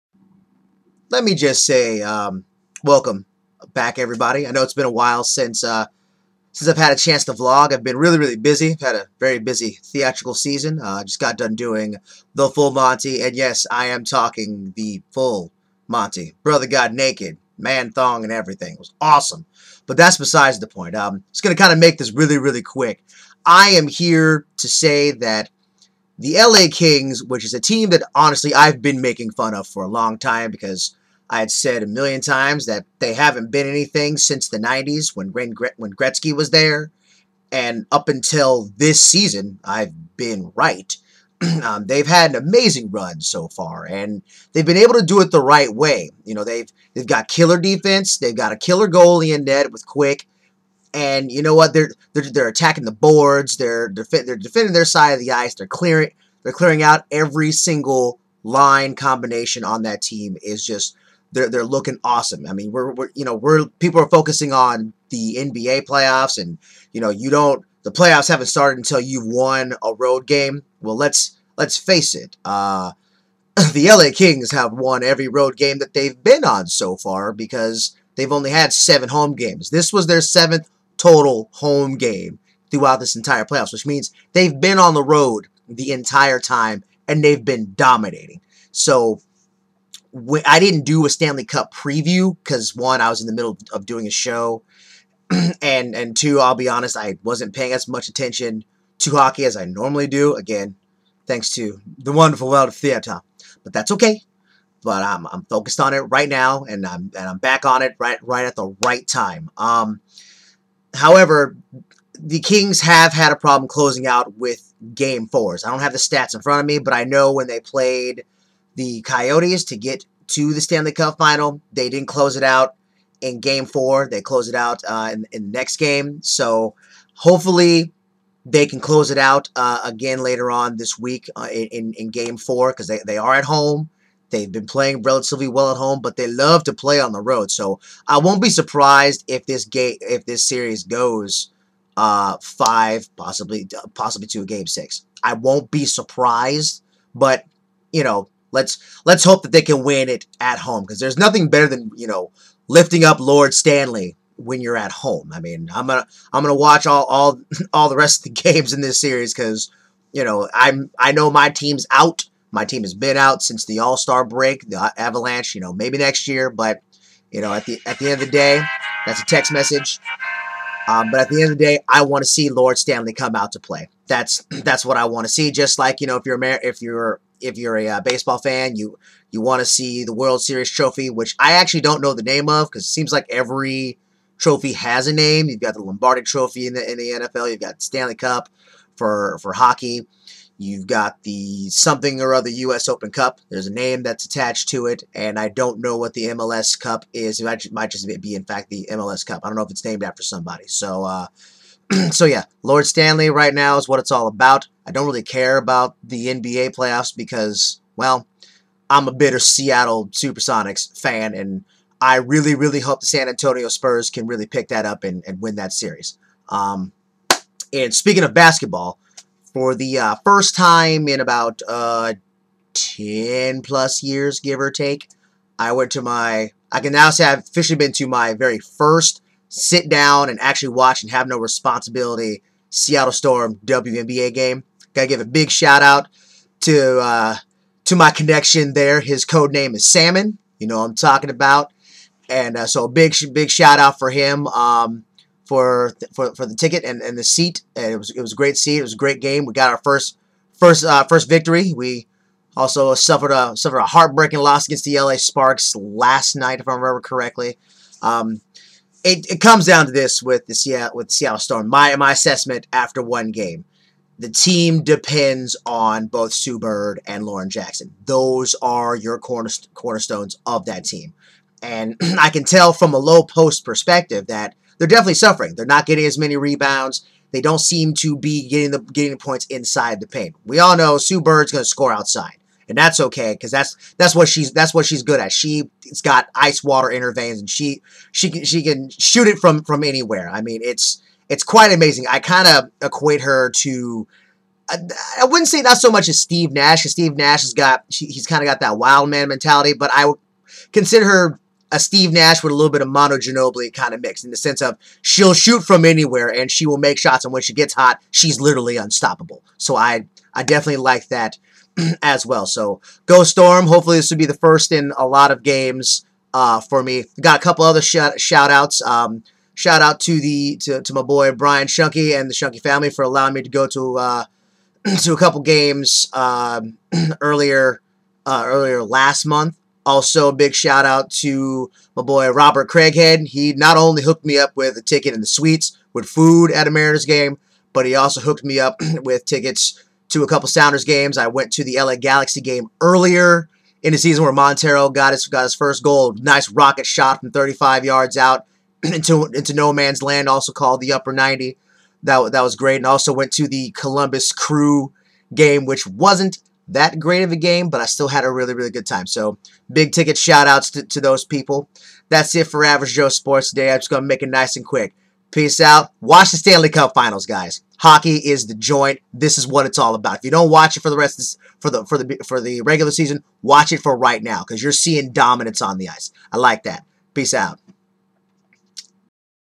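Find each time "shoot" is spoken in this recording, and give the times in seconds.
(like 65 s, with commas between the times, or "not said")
288 s, 305 s.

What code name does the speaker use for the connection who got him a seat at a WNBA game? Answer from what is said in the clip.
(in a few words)
Salmon.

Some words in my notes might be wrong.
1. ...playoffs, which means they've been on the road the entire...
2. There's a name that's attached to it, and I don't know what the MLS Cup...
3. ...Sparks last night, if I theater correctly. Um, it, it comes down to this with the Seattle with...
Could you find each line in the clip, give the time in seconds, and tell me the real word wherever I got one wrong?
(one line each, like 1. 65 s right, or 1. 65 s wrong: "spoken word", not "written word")
1. 83 s right
2. 193 s right
3. 255 s wrong: "remember", not "theater".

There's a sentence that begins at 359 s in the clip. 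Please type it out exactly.
So big ticket shout outs to, to those people.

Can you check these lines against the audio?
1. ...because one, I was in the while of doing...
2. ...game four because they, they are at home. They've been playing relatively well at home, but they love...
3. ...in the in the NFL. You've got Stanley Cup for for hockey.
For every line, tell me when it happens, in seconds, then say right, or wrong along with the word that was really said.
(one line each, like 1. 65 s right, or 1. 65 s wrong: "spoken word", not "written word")
1. 92 s wrong: "middle", not "while"
2. 132 s right
3. 186 s right.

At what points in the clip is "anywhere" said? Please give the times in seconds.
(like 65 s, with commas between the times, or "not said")
289 s, 305 s.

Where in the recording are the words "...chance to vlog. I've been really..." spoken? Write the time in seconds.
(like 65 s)
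6 s.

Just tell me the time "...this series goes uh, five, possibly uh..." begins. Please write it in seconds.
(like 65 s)
140 s.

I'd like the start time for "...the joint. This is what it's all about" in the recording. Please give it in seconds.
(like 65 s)
368 s.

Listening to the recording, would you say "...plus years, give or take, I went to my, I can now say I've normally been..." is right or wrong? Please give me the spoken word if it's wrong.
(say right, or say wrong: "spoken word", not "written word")
wrong: "officially", not "normally".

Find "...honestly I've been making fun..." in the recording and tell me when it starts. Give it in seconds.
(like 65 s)
28 s.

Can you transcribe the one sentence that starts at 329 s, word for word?
Also, a big shout out to my boy Robert Craighead.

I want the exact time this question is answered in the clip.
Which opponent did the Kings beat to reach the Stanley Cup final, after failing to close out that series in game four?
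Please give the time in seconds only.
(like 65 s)
119 s.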